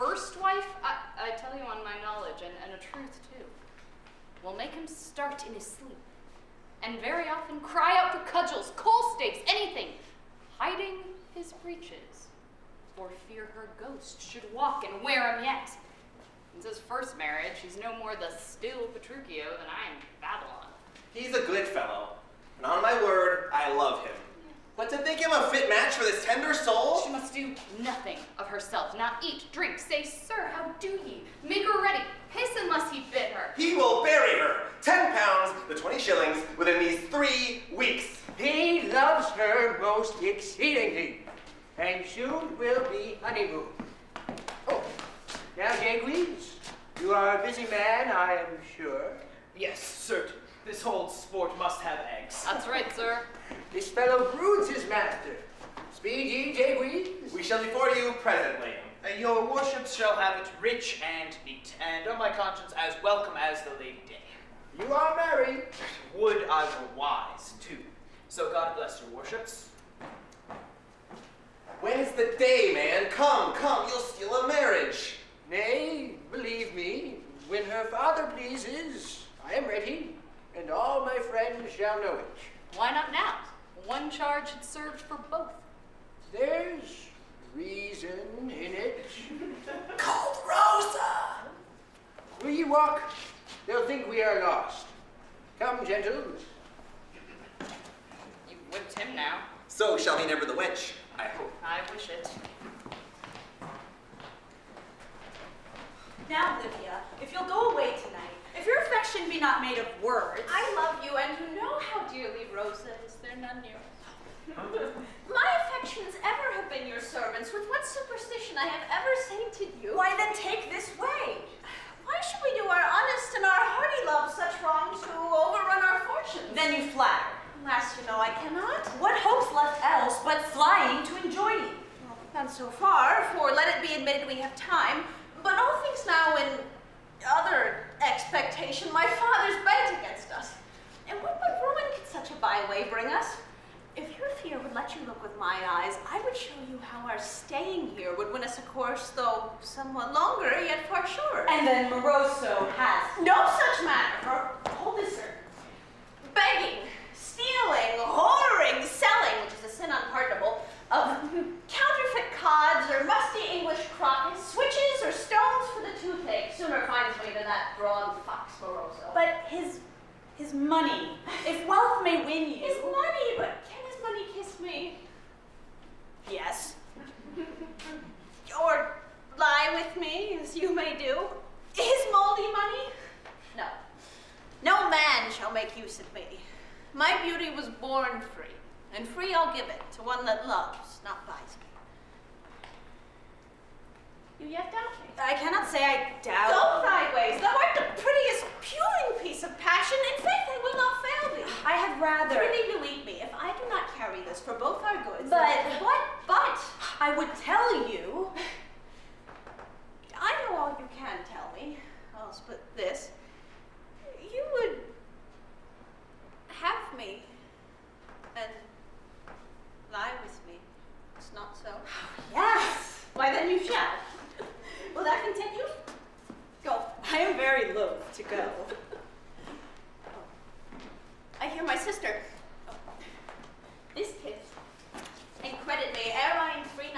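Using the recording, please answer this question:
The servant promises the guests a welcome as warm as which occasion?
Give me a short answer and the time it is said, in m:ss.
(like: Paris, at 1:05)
Lady Day, at 1:03.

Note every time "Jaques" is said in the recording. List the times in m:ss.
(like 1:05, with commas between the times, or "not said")
0:45, 0:56.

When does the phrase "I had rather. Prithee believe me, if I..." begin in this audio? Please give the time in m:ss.
3:21.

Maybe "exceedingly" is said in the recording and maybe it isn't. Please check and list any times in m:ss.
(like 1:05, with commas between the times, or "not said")
0:40.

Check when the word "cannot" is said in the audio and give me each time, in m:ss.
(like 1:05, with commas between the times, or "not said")
2:08, 3:15.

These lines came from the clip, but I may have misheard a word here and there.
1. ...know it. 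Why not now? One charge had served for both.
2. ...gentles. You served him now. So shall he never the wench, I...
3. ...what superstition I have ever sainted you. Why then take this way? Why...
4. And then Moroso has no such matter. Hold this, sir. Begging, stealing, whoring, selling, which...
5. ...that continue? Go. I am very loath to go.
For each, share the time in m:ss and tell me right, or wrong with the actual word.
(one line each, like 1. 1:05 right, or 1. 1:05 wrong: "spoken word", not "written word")
1. 1:22 right
2. 1:35 wrong: "whipped", not "served"
3. 1:57 right
4. 2:31 right
5. 3:45 right.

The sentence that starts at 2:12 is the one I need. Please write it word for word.
Well, not so far, for let it be admitted we have time.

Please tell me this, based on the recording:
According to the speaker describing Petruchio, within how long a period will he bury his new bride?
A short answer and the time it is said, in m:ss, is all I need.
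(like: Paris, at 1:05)
3 weeks, at 0:37.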